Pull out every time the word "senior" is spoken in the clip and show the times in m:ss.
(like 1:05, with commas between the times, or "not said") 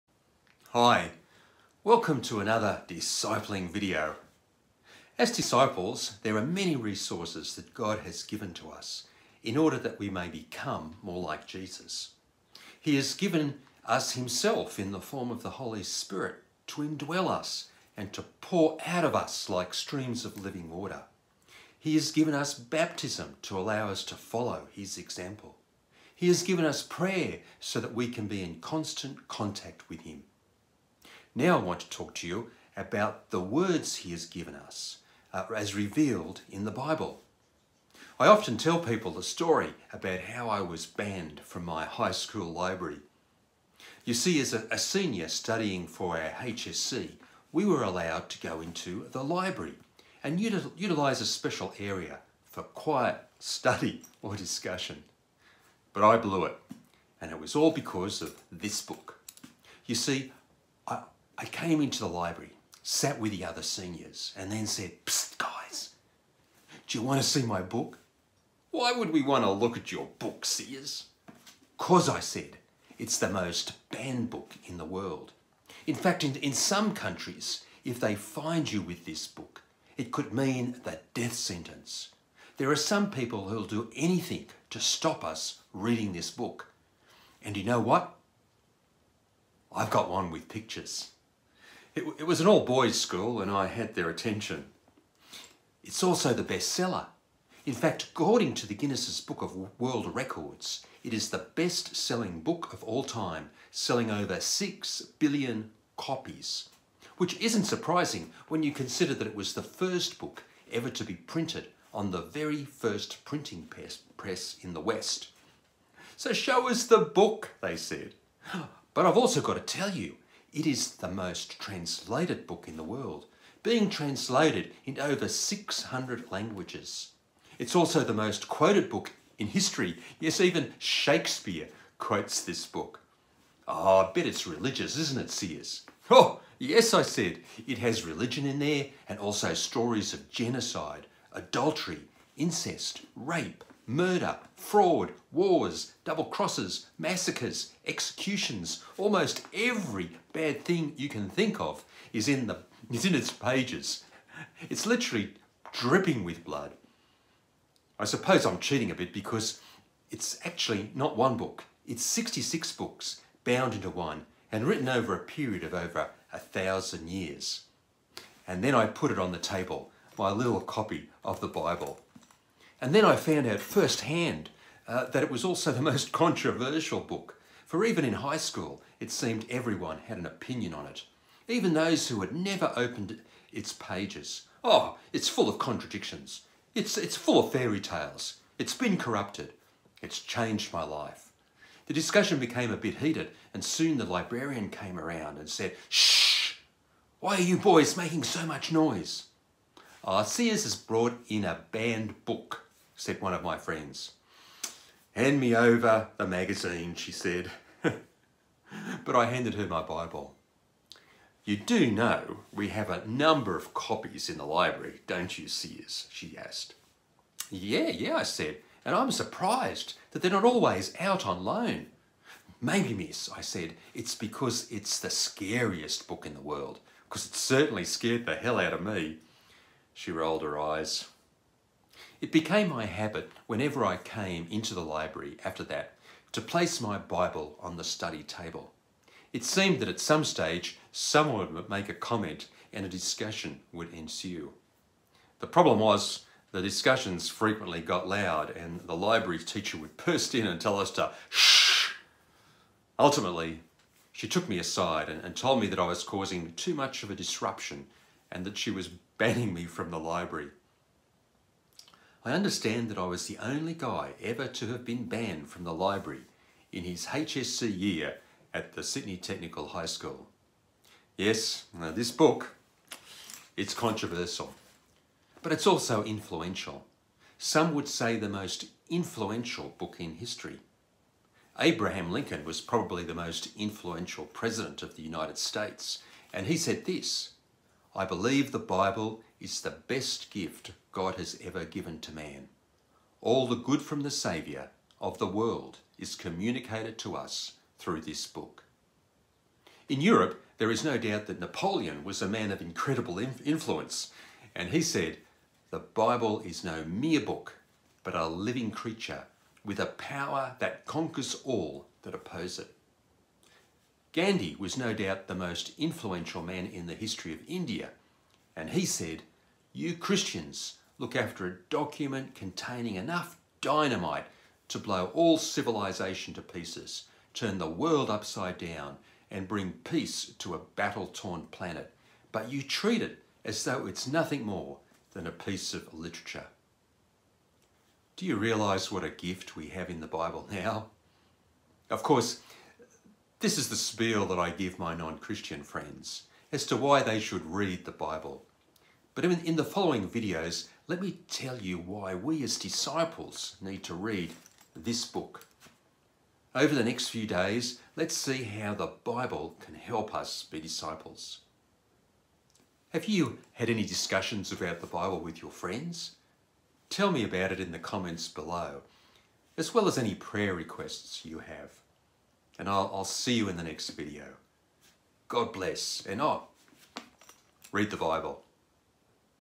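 0:44, 1:03.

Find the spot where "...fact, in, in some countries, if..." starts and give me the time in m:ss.
1:15.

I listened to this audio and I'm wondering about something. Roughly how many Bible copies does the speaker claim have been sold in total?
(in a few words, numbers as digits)
over 6 billion.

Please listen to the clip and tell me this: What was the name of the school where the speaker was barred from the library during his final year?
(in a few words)
Sydney Technical High School.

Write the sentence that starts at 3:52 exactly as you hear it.
It became my habit whenever I came into the library after that to place my Bible on the study table.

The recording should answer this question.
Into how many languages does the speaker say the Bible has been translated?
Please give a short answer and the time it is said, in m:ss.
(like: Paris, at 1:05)
over 600, at 2:04.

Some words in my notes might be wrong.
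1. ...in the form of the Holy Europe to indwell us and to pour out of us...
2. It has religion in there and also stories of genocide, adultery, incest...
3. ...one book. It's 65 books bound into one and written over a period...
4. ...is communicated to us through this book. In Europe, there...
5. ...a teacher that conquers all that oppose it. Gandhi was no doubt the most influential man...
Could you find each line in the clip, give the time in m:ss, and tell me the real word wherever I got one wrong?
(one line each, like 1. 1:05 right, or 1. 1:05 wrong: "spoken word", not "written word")
1. 0:14 wrong: "Spirit", not "Europe"
2. 2:17 right
3. 2:41 wrong: "66", not "65"
4. 4:55 right
5. 5:09 wrong: "power", not "teacher".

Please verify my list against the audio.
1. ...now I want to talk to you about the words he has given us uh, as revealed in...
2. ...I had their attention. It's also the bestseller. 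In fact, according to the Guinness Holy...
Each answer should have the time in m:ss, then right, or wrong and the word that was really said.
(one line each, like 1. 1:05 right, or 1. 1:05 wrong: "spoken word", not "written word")
1. 0:31 right
2. 1:33 wrong: "Book", not "Holy".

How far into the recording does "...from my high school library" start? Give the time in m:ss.
0:41.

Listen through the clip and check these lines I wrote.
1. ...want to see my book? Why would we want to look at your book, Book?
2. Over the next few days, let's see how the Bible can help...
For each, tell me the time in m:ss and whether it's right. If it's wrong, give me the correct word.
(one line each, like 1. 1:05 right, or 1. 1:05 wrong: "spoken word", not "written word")
1. 1:07 wrong: "Siers", not "Book"
2. 5:56 right.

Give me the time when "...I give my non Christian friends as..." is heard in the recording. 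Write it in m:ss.
5:44.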